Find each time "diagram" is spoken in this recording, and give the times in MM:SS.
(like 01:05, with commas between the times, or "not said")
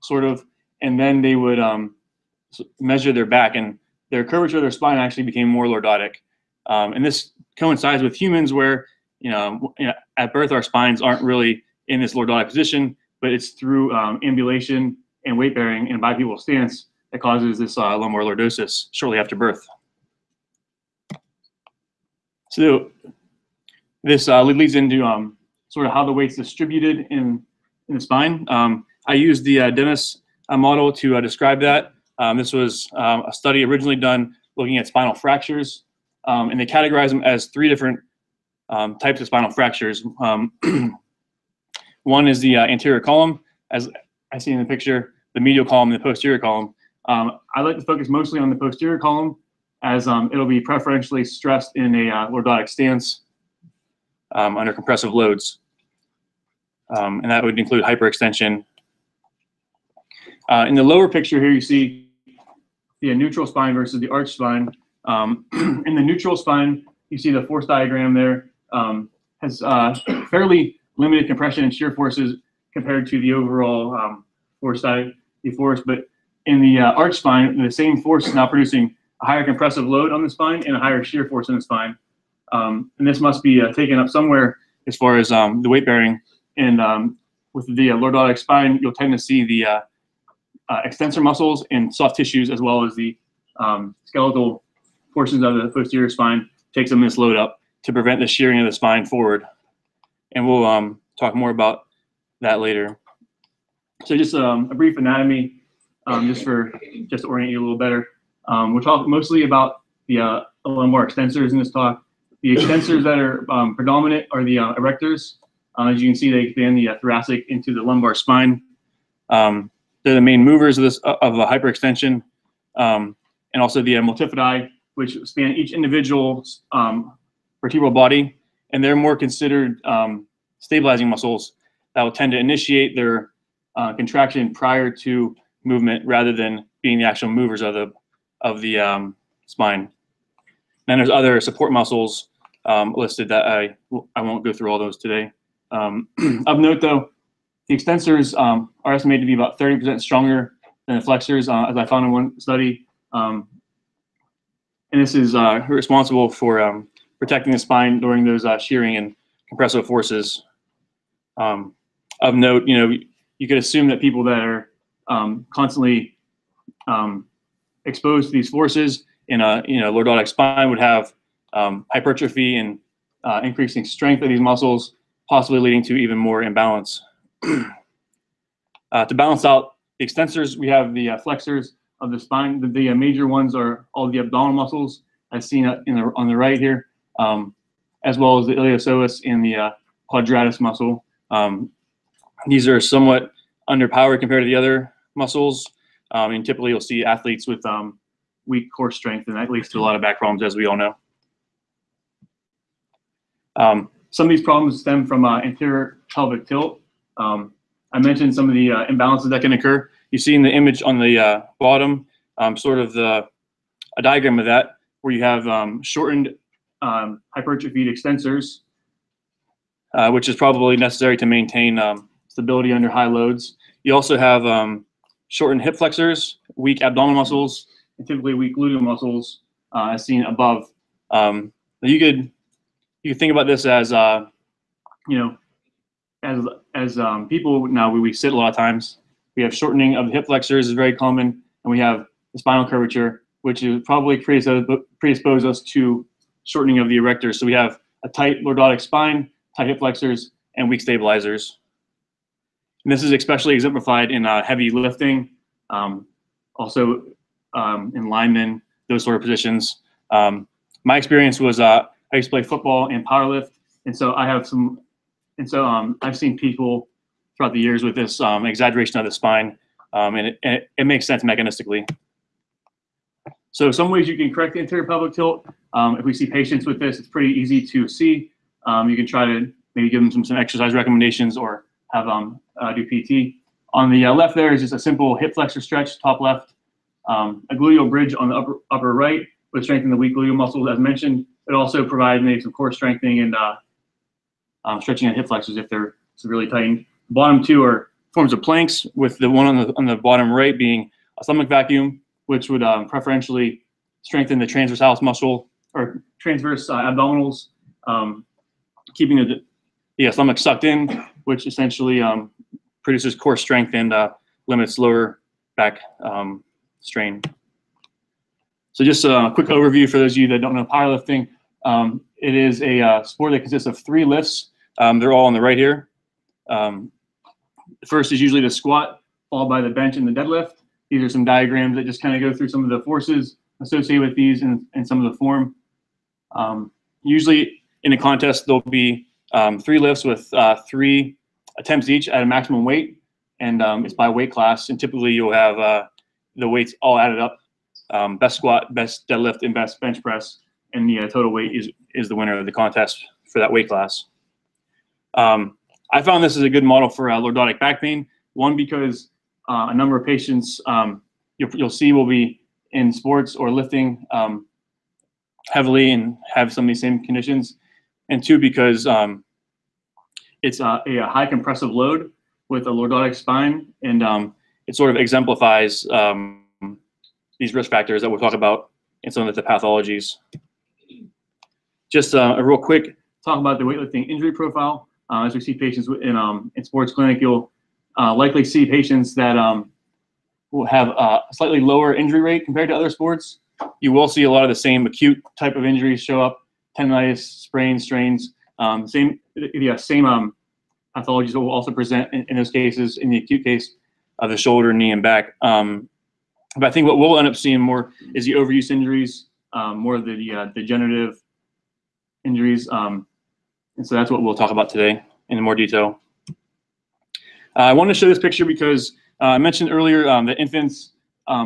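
01:07, 03:34, 05:31.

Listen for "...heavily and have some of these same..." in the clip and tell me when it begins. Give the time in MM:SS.
06:05.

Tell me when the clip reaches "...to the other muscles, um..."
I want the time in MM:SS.
03:14.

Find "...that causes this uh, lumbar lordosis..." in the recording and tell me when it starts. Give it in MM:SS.
00:17.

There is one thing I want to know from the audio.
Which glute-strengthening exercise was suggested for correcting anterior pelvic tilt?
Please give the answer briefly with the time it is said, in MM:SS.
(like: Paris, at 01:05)
gluteal bridge, at 04:47.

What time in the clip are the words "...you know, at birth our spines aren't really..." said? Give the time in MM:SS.
00:09.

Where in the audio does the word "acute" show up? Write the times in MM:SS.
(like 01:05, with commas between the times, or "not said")
06:34, 06:43.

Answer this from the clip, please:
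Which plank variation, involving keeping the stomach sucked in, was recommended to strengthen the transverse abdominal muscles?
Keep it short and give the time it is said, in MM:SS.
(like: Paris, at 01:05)
stomach vacuum, at 05:01.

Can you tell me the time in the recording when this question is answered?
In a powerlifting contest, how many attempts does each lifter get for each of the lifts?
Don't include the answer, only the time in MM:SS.
05:40.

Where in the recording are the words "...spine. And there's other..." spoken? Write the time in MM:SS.
02:19.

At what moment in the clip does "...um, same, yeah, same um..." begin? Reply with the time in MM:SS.
06:38.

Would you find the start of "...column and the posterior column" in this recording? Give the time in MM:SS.
00:45.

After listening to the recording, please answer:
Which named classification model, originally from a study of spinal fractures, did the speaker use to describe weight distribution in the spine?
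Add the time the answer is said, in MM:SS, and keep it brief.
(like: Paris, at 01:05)
Dennis model, at 00:29.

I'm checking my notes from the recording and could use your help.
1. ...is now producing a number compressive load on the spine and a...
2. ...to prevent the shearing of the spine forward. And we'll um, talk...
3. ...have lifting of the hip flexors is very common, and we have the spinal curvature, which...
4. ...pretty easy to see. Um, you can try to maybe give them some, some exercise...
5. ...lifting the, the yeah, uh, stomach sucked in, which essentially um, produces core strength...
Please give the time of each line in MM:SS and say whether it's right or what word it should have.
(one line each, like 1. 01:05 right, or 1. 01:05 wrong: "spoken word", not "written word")
1. 01:18 wrong: "higher", not "number"
2. 01:37 right
3. 03:59 wrong: "shortening", not "lifting"
4. 04:37 right
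5. 05:08 wrong: "keeping", not "lifting".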